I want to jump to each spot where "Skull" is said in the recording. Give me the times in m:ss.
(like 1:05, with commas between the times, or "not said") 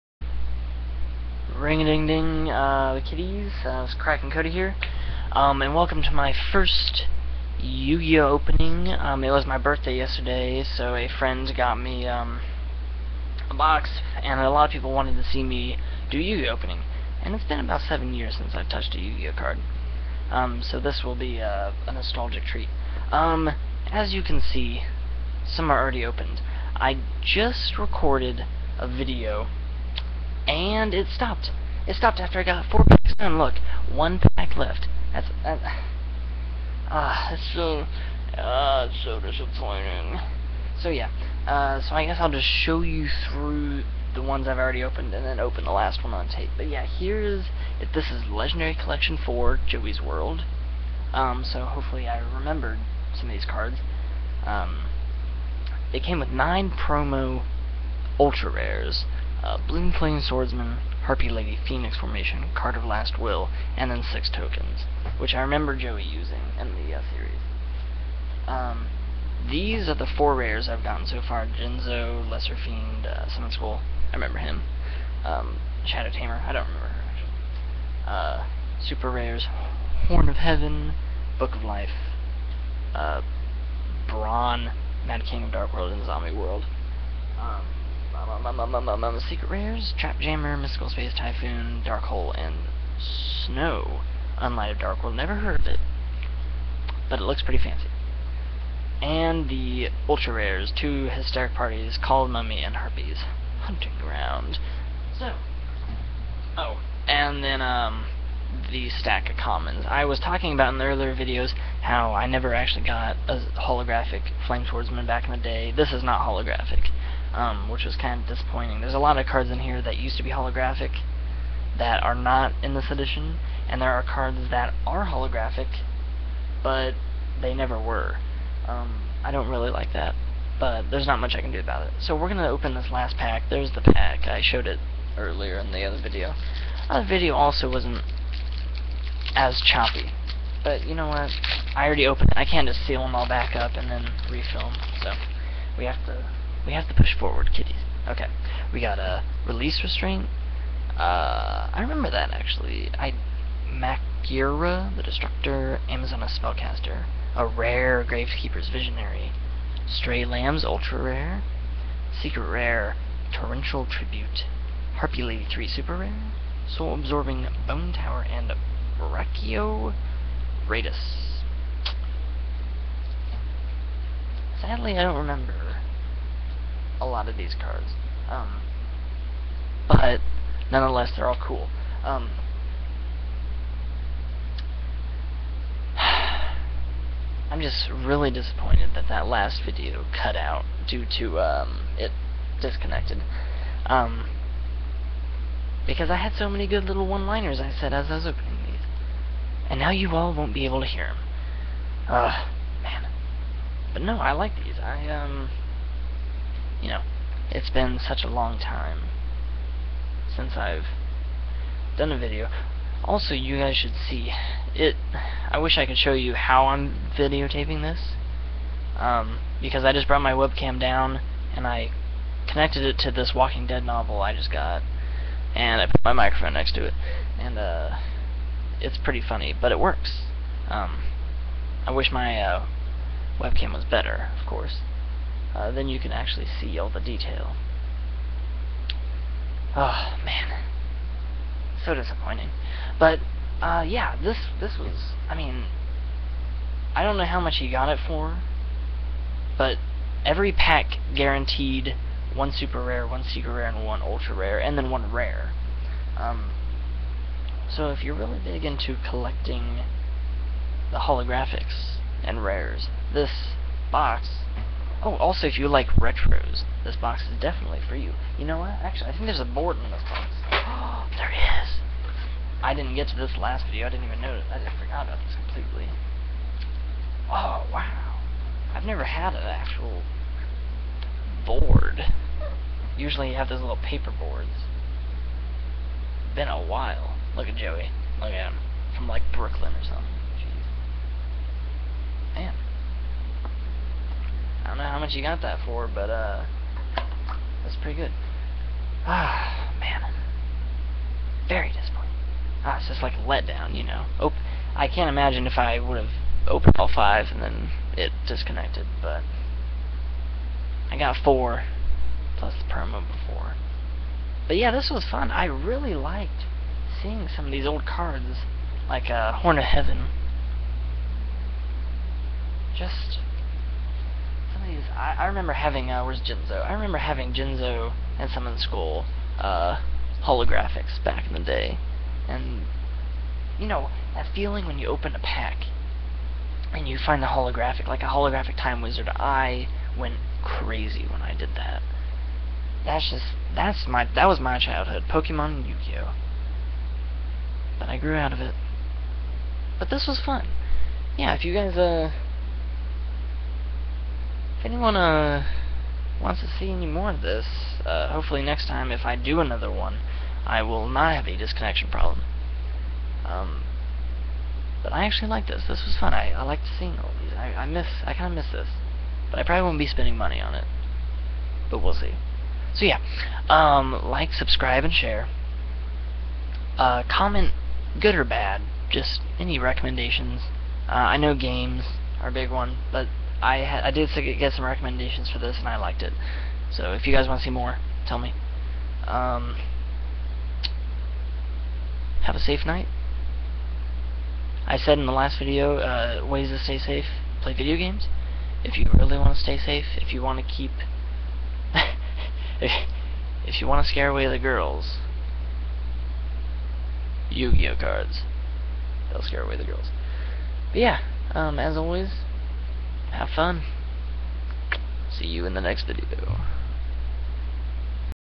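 1:13, 5:28.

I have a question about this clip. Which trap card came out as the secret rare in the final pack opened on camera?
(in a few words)
Torrential Tribute.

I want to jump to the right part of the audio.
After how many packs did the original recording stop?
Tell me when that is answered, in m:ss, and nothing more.
0:32.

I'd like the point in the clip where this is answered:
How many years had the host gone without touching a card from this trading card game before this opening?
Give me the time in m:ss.
0:17.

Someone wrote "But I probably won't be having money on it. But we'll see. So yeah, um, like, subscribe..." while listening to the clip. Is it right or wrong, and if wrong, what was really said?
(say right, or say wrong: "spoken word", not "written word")
wrong: "spending", not "having".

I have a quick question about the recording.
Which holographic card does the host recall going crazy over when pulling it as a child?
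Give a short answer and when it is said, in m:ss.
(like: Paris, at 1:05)
Time Wizard, at 5:38.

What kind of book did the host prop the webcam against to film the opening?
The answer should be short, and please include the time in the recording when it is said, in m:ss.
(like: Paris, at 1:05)
Walking Dead novel, at 3:43.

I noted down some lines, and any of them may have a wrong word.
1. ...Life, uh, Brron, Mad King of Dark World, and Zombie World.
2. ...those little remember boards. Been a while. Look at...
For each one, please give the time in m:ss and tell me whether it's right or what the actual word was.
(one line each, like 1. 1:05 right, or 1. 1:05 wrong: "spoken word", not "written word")
1. 1:21 right
2. 4:43 wrong: "paper", not "remember".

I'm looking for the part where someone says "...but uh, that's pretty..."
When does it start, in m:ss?
4:55.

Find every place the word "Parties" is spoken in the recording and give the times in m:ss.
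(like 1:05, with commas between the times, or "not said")
1:41.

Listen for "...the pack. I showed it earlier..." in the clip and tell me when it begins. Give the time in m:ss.
2:13.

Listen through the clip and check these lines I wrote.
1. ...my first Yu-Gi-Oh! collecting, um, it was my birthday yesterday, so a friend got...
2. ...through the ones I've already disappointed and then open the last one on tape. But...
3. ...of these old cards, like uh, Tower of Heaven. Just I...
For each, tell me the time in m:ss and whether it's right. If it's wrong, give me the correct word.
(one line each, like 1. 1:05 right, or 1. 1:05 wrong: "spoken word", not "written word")
1. 0:06 wrong: "opening", not "collecting"
2. 0:43 wrong: "opened", not "disappointed"
3. 5:17 wrong: "Horn", not "Tower".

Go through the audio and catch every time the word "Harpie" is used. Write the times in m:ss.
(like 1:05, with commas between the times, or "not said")
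1:01, 1:42, 2:44.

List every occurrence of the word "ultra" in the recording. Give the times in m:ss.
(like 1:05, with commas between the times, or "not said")
0:58, 1:40, 2:40, 4:14.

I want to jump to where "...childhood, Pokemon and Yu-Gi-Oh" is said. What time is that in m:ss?
5:44.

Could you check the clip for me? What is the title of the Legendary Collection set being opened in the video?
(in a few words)
Joey's World.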